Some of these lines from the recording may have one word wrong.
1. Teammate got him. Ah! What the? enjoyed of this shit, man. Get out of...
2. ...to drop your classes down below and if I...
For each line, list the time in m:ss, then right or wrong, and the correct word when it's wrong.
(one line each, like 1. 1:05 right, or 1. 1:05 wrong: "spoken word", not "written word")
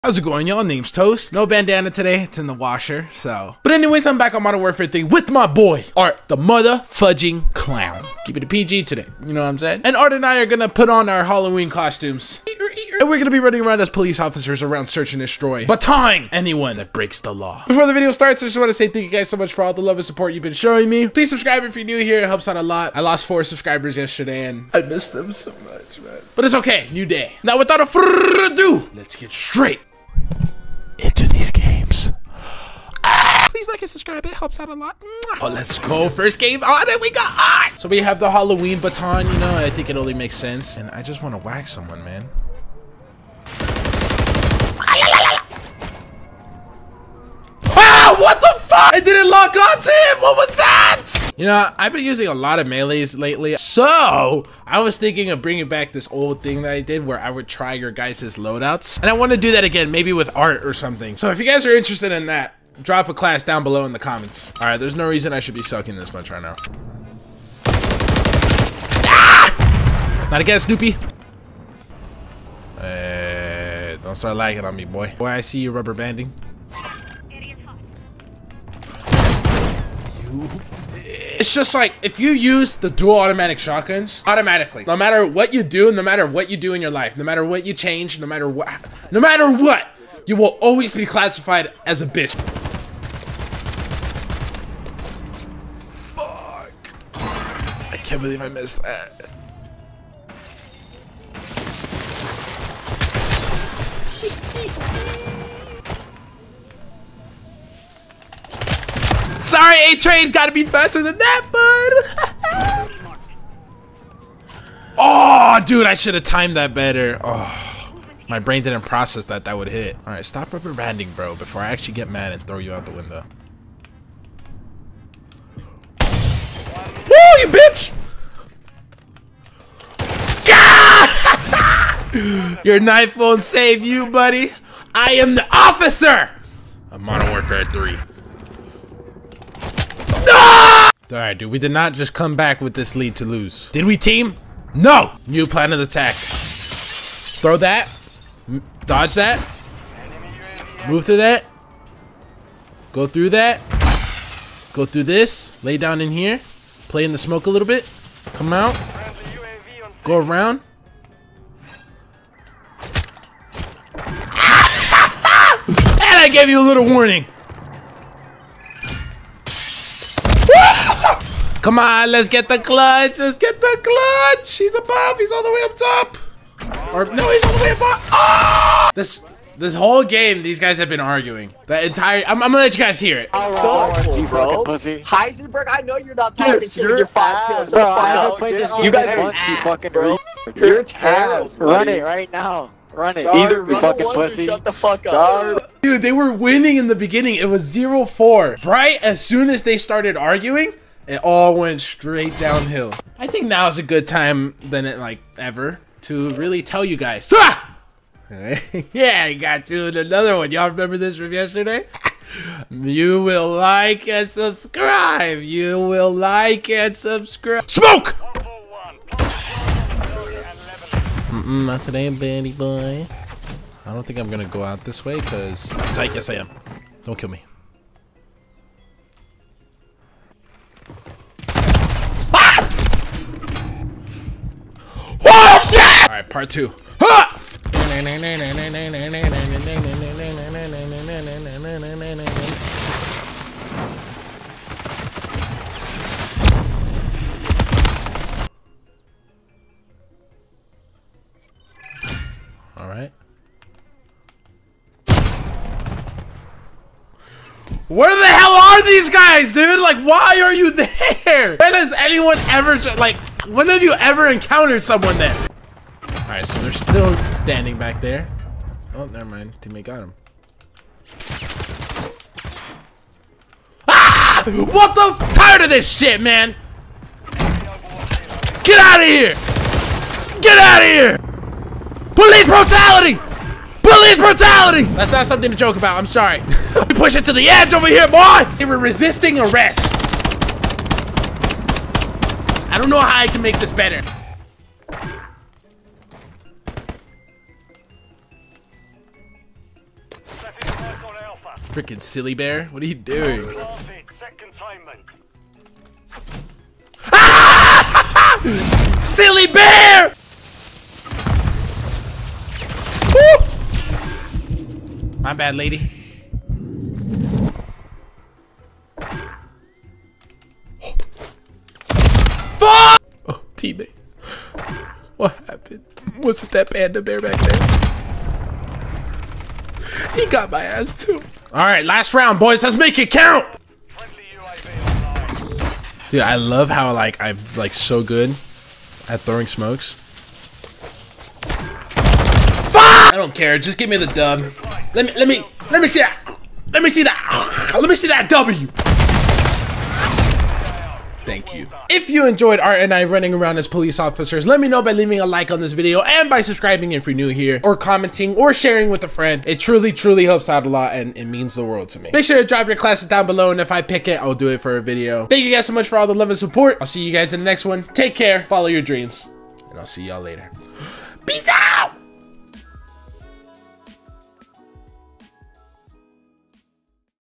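1. 4:29 wrong: "tired", not "enjoyed"
2. 6:02 right.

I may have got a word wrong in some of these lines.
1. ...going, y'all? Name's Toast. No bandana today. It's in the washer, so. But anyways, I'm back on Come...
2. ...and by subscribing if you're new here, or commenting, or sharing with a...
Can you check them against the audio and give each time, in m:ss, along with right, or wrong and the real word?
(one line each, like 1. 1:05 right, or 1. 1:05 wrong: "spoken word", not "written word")
1. 0:00 wrong: "Modern", not "Come"
2. 5:56 right.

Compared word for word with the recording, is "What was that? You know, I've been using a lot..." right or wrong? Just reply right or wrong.
right.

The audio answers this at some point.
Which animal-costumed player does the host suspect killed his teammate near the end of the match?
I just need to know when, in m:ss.
5:26.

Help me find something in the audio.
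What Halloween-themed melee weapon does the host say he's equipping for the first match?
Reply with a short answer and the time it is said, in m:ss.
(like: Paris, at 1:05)
Baton, at 0:38.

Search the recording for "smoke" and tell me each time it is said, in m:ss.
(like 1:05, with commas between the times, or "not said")
2:37, 3:37, 5:39.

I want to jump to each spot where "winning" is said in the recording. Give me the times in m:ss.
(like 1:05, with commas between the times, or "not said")
3:16.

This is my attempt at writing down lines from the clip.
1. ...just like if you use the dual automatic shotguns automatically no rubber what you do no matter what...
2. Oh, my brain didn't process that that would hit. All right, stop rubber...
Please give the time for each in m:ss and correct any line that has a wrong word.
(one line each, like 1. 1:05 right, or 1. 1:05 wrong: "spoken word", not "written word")
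1. 1:21 wrong: "matter", not "rubber"
2. 1:57 right.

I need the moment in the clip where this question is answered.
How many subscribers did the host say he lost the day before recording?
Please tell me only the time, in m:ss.
0:23.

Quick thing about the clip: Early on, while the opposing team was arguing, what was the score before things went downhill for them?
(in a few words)
0-4.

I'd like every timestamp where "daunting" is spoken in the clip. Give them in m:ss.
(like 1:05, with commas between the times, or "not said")
not said.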